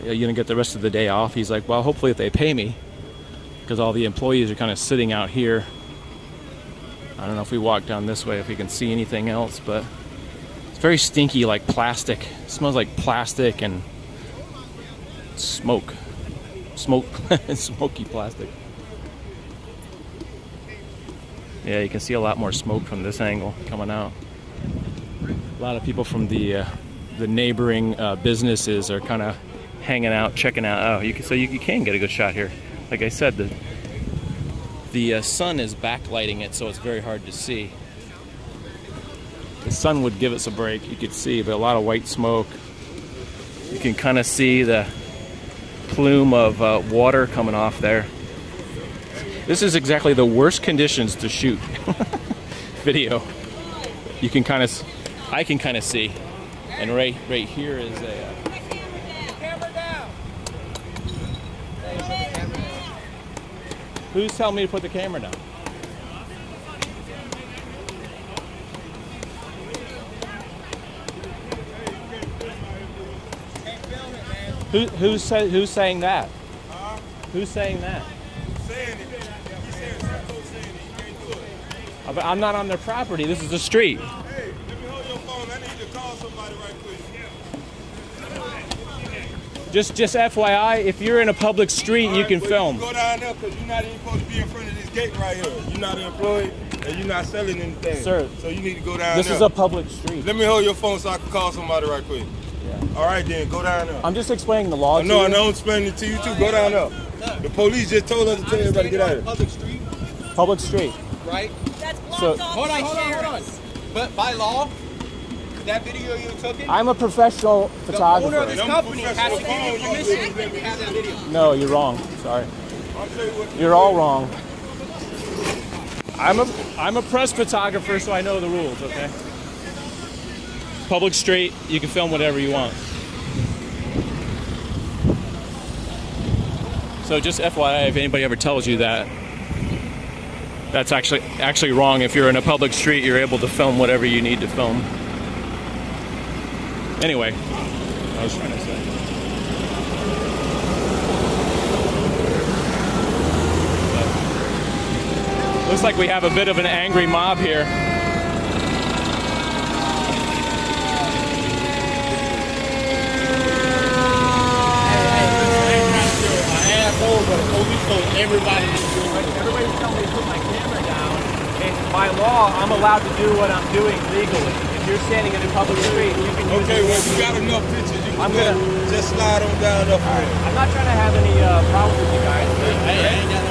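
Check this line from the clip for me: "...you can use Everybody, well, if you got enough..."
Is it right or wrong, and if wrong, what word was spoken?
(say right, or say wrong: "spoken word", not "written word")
wrong: "Okay", not "Everybody".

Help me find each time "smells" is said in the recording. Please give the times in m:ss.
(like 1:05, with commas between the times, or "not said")
0:12.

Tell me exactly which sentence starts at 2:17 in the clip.
So just FYI, if anybody ever tells you that, that's actually actually wrong.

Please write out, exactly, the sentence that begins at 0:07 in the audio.
I don't know if we walk down this way, if we can see anything else, but it's very stinky, like plastic.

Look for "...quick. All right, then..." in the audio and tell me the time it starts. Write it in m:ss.
1:42.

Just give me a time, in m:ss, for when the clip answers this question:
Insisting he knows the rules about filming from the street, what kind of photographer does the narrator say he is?
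2:07.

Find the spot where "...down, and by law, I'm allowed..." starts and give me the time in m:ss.
2:50.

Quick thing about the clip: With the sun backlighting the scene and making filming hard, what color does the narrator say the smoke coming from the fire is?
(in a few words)
white.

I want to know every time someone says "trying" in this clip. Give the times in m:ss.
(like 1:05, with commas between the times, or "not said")
2:28, 3:00.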